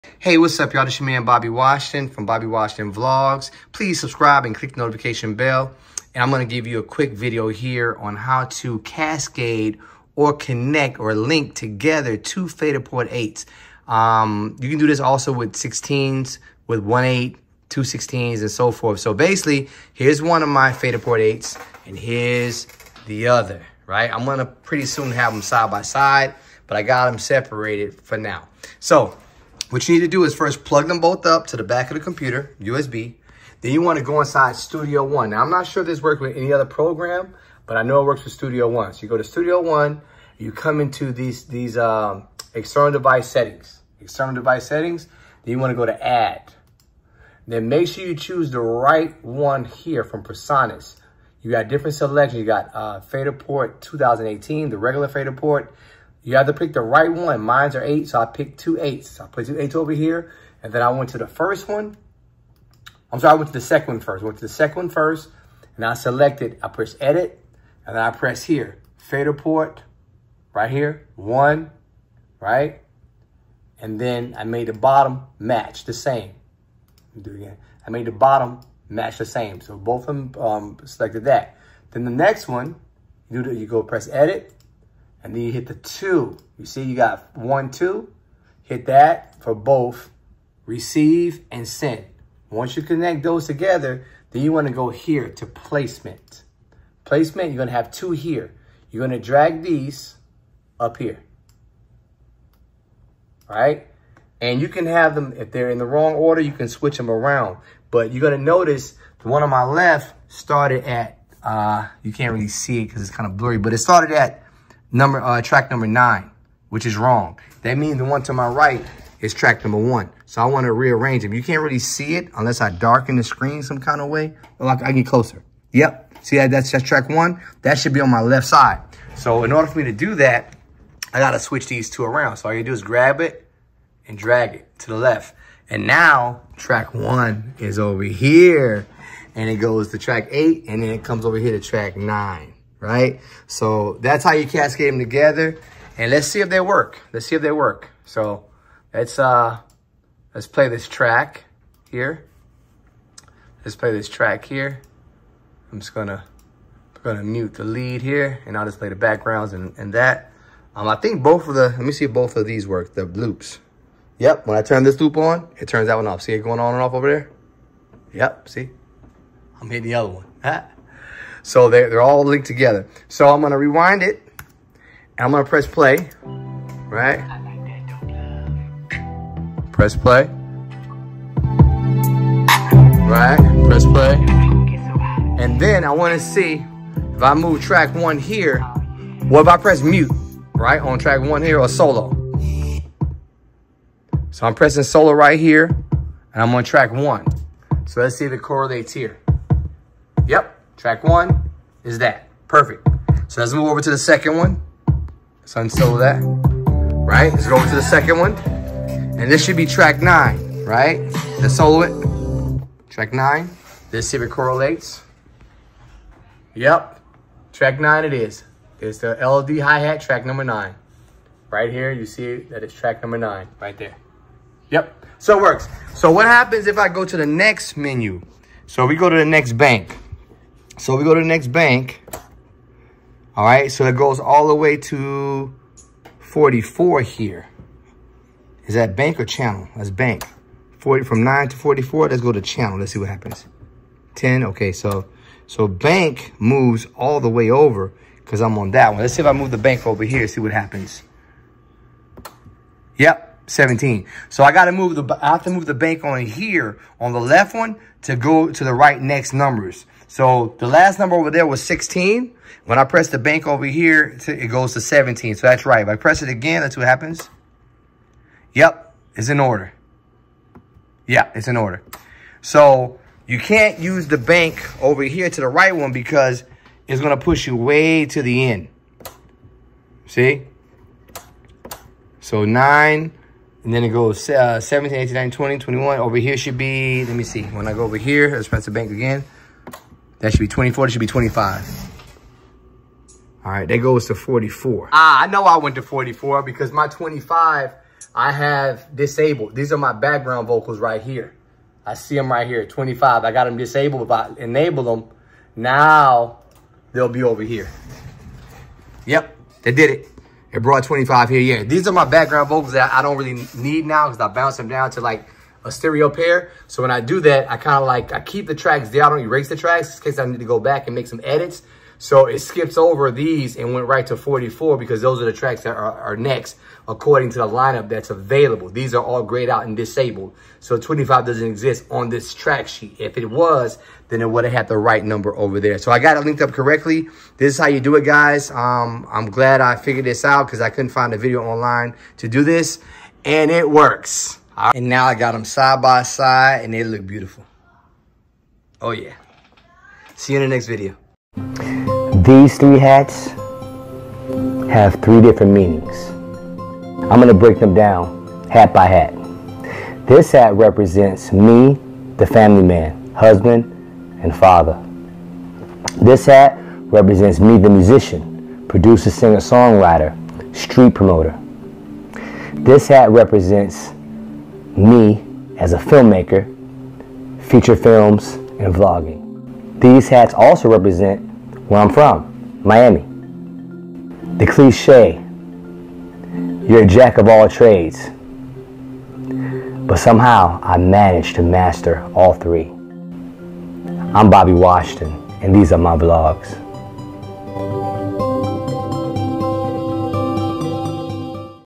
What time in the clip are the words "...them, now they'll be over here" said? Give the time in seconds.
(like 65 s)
304 s.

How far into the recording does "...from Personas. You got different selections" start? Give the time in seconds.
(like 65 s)
50 s.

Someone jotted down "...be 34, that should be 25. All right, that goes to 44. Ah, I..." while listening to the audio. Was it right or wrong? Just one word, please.
wrong.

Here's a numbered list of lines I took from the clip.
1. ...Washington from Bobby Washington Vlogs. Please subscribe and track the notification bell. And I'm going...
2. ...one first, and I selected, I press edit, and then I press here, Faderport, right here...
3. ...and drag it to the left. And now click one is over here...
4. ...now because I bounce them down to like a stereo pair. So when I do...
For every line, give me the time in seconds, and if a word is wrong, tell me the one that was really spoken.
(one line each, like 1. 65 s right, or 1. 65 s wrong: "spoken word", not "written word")
1. 1 s wrong: "click", not "track"
2. 64 s right
3. 134 s wrong: "track", not "click"
4. 313 s right.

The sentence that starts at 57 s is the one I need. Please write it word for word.
Mines are eight, so I picked two eights.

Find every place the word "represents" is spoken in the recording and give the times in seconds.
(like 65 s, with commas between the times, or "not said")
360 s, 366 s, 373 s, 380 s.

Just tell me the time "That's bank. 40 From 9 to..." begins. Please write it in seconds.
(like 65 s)
239 s.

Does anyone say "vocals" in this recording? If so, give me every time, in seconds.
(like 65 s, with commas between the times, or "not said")
300 s, 312 s.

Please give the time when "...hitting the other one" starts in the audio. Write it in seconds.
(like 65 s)
169 s.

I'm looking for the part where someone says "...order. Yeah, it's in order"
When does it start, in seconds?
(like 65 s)
269 s.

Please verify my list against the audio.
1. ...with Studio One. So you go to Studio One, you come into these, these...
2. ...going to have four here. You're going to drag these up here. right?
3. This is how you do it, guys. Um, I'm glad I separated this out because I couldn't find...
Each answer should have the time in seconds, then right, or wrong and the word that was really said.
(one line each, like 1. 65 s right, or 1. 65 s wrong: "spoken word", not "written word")
1. 38 s right
2. 97 s wrong: "two", not "four"
3. 337 s wrong: "figured", not "separated".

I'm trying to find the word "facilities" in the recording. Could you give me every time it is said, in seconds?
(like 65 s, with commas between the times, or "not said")
not said.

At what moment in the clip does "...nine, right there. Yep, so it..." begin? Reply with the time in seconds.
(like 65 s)
223 s.